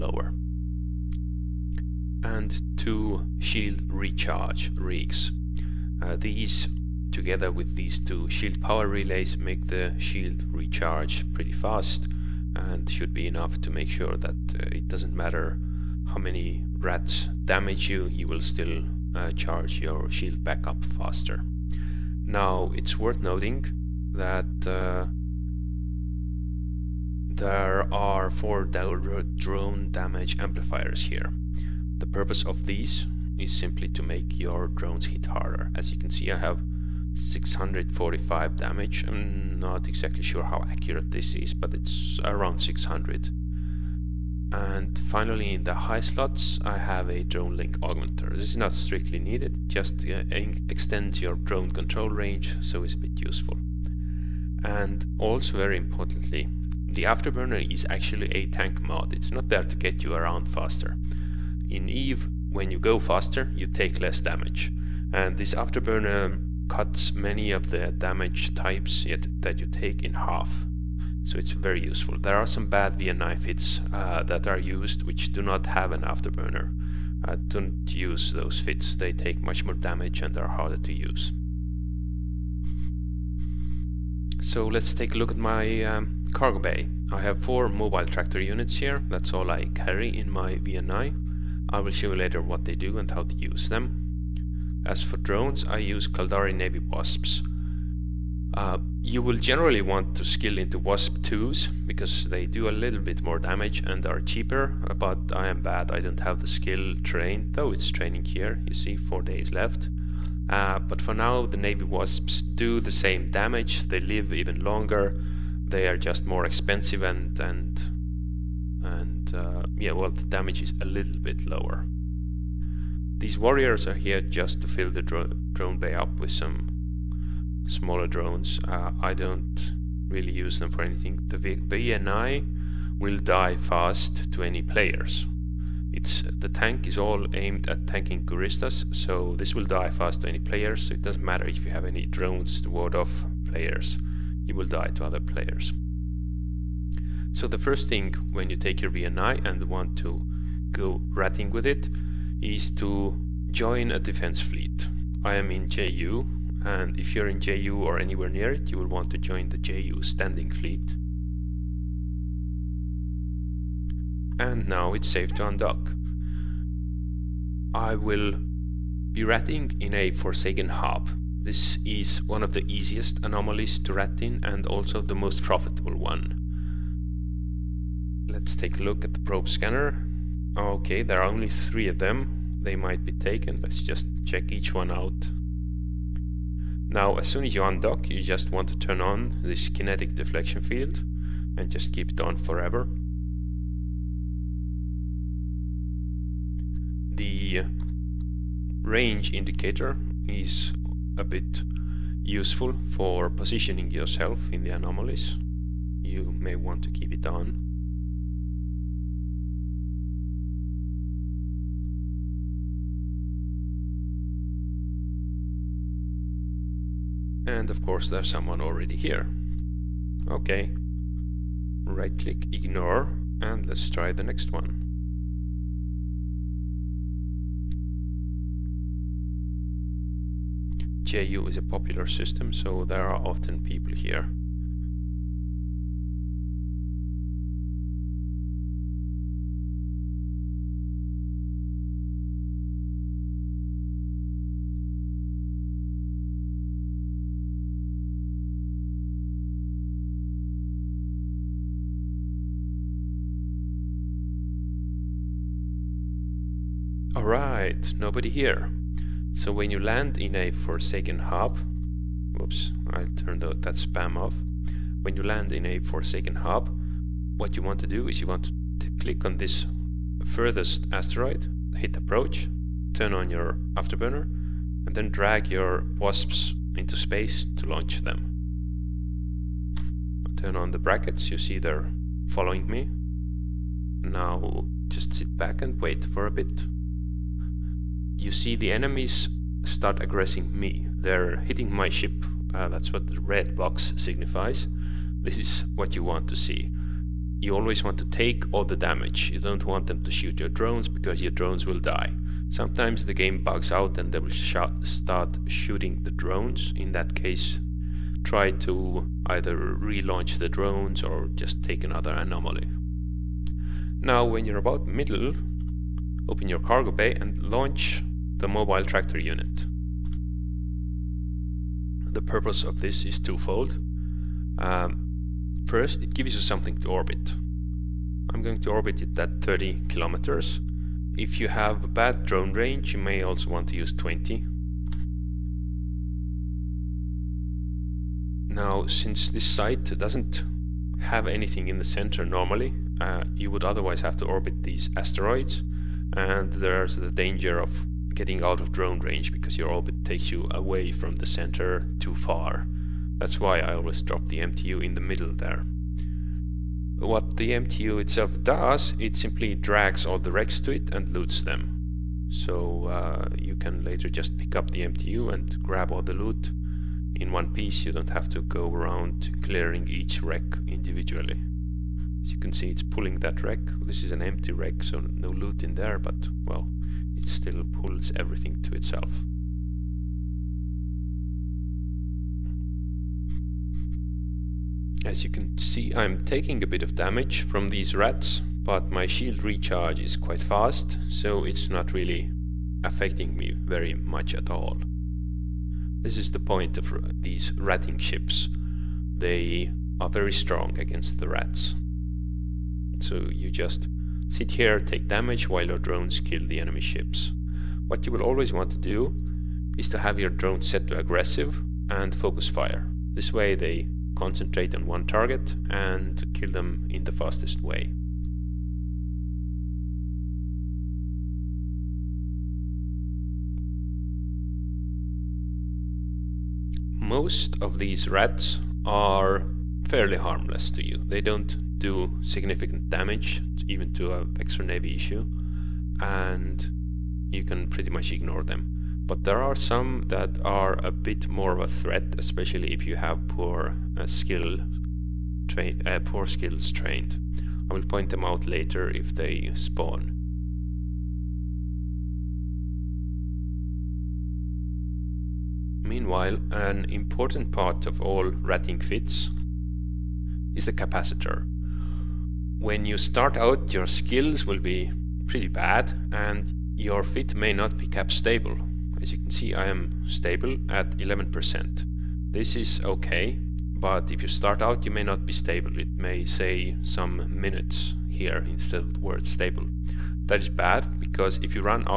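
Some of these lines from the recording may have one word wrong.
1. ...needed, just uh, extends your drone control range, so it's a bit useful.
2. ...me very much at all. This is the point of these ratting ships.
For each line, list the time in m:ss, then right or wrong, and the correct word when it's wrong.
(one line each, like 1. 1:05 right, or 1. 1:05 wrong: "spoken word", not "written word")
1. 0:49 right
2. 6:33 right.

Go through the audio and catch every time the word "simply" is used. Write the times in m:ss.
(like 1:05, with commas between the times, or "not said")
0:33, 5:59.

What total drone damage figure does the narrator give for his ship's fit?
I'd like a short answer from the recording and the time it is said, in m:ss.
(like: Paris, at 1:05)
645, at 0:37.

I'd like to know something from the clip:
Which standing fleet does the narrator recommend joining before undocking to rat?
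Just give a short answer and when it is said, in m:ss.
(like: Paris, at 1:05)
JU standing fleet, at 2:39.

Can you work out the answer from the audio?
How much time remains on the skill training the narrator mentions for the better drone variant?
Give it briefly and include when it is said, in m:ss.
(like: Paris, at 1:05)
4 days, at 1:48.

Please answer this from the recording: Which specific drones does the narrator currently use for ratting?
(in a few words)
Caldari Navy Wasps.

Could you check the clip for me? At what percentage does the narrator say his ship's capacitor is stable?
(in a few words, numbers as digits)
11%.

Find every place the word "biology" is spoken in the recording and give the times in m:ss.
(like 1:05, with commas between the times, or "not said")
not said.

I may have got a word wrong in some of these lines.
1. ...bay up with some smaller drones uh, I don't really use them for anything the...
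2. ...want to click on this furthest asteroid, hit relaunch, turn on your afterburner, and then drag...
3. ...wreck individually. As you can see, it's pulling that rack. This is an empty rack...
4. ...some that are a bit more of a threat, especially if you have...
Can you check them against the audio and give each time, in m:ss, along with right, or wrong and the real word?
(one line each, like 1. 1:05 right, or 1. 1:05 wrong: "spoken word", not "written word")
1. 2:05 right
2. 4:28 wrong: "approach", not "relaunch"
3. 6:10 right
4. 7:19 right.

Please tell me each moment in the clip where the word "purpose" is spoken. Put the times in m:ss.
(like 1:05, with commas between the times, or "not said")
0:32, 5:22.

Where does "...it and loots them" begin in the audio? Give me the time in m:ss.
6:00.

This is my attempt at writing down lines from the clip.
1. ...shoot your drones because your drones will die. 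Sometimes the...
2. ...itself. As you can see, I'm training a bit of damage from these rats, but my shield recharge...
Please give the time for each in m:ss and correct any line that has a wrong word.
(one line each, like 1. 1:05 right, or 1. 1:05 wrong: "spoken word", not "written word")
1. 5:00 right
2. 6:18 wrong: "taking", not "training".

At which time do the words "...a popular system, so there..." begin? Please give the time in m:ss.
3:51.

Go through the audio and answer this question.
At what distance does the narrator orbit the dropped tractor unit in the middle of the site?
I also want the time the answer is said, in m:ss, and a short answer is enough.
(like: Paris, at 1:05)
30 kilometers, at 5:29.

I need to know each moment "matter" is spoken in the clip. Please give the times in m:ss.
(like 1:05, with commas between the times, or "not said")
0:15, 2:21.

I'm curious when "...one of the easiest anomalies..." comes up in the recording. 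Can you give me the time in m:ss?
2:52.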